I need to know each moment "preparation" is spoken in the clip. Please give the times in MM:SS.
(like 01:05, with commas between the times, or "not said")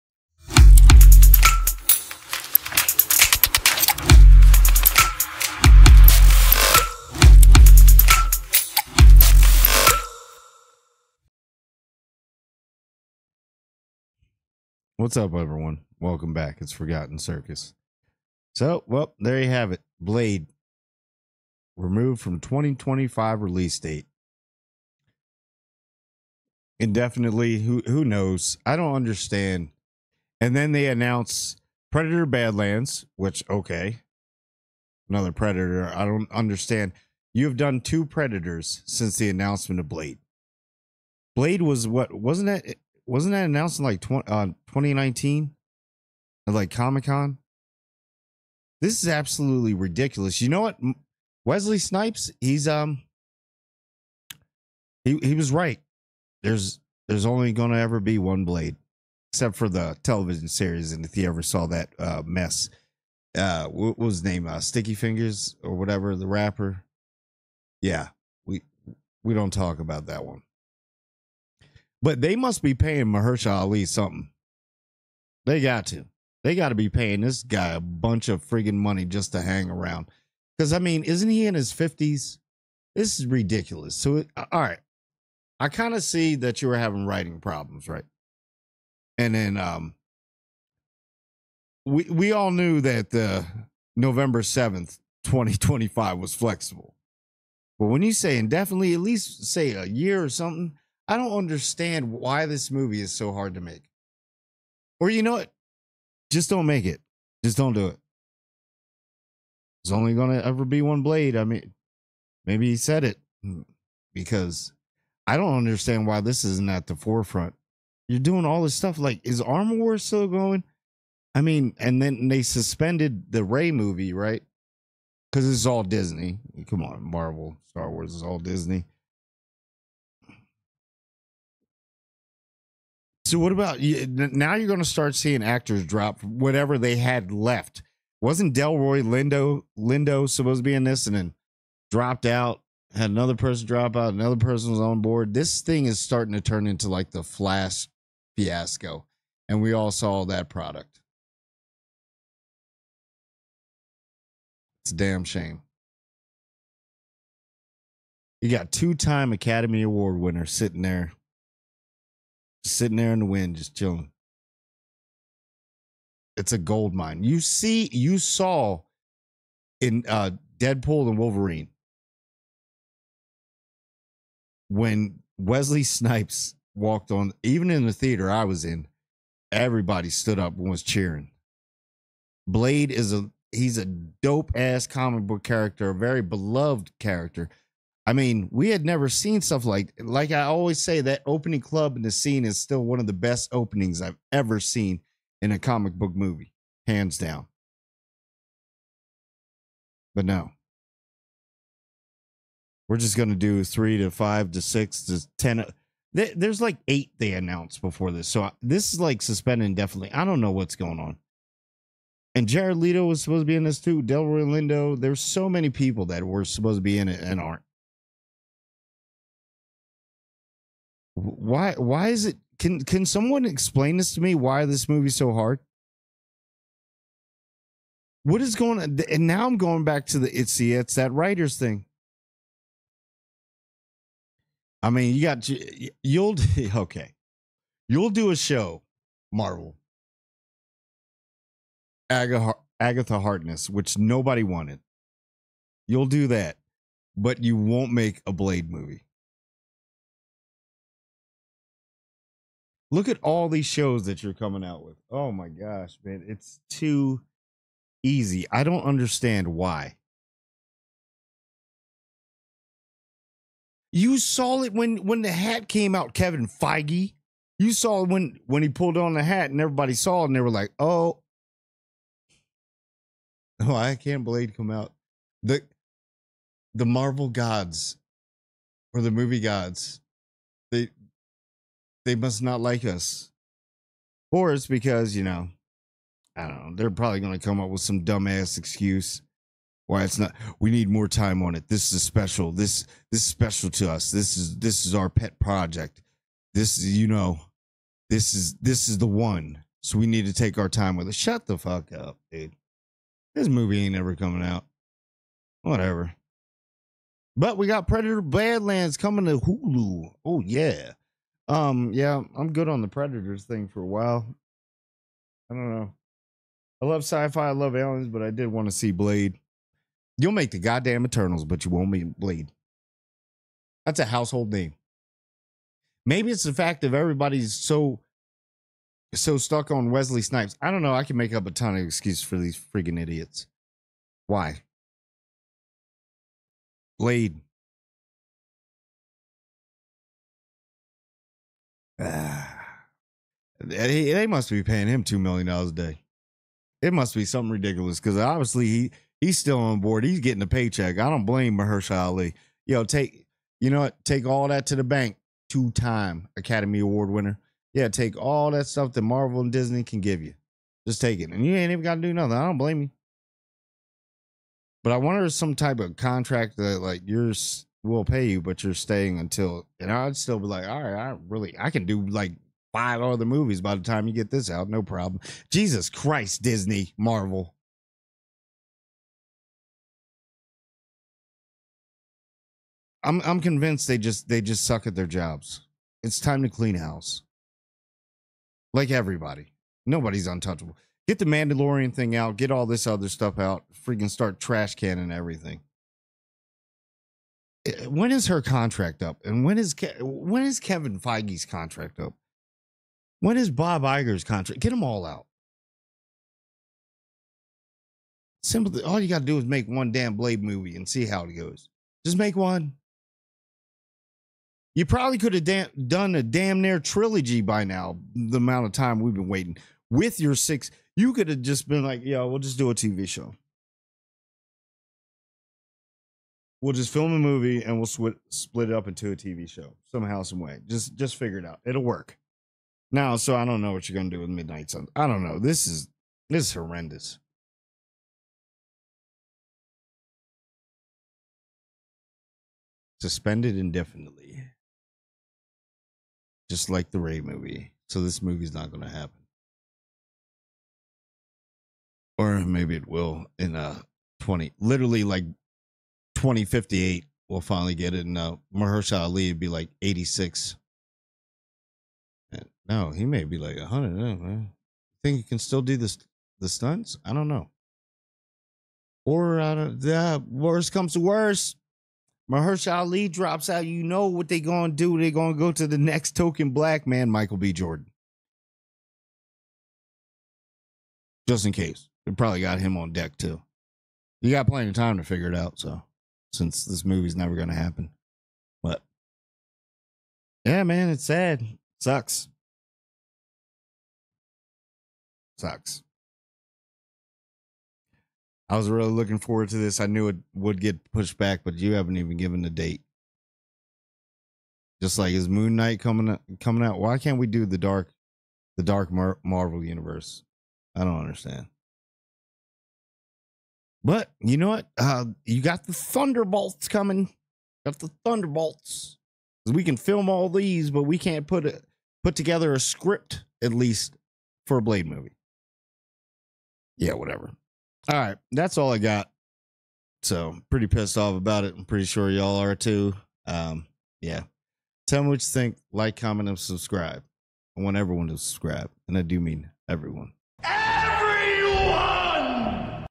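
not said.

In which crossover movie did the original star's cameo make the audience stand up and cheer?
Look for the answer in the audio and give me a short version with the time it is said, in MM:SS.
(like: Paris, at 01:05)
Deadpool and Wolverine, at 02:50.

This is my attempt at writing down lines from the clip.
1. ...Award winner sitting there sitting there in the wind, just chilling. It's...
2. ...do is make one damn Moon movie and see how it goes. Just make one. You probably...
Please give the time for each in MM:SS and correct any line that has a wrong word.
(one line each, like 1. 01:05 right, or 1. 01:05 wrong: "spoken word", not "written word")
1. 02:39 right
2. 06:49 wrong: "Blade", not "Moon".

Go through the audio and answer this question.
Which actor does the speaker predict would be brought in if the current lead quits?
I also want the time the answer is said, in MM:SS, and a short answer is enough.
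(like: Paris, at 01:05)
Michael B. Jordan, at 07:57.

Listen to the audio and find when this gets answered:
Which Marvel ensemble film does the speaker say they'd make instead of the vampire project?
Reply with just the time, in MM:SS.
05:21.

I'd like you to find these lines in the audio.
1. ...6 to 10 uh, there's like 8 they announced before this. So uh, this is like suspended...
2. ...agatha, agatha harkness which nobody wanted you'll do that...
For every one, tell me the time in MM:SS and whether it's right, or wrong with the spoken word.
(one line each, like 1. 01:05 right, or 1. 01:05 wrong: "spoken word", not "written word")
1. 03:24 right
2. 04:02 right.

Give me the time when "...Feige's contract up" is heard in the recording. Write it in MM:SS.
06:40.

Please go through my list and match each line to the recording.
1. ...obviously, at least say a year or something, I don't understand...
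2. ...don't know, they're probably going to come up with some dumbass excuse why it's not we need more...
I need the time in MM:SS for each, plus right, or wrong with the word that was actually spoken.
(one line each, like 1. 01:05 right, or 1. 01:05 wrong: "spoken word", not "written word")
1. 01:38 wrong: "indefinitely", not "obviously"
2. 04:46 right.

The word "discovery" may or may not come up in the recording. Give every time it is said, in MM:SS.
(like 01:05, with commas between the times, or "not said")
not said.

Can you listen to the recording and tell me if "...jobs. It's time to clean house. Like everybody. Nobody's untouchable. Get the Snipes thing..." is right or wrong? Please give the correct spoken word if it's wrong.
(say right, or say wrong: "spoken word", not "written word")
wrong: "Mandalorian", not "Snipes".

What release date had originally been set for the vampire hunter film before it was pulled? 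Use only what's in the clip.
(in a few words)
November 7, 2025.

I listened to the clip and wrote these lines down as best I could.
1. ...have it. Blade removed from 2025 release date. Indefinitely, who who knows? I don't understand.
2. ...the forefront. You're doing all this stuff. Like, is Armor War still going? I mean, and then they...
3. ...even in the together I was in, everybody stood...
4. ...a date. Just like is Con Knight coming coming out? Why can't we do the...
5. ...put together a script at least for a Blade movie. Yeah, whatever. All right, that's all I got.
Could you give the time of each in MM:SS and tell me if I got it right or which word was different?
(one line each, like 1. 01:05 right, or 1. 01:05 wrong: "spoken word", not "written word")
1. 00:19 right
2. 01:56 right
3. 02:57 wrong: "theater", not "together"
4. 08:22 wrong: "Moon", not "Con"
5. 08:42 right.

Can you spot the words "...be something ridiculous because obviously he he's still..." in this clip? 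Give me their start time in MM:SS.
05:47.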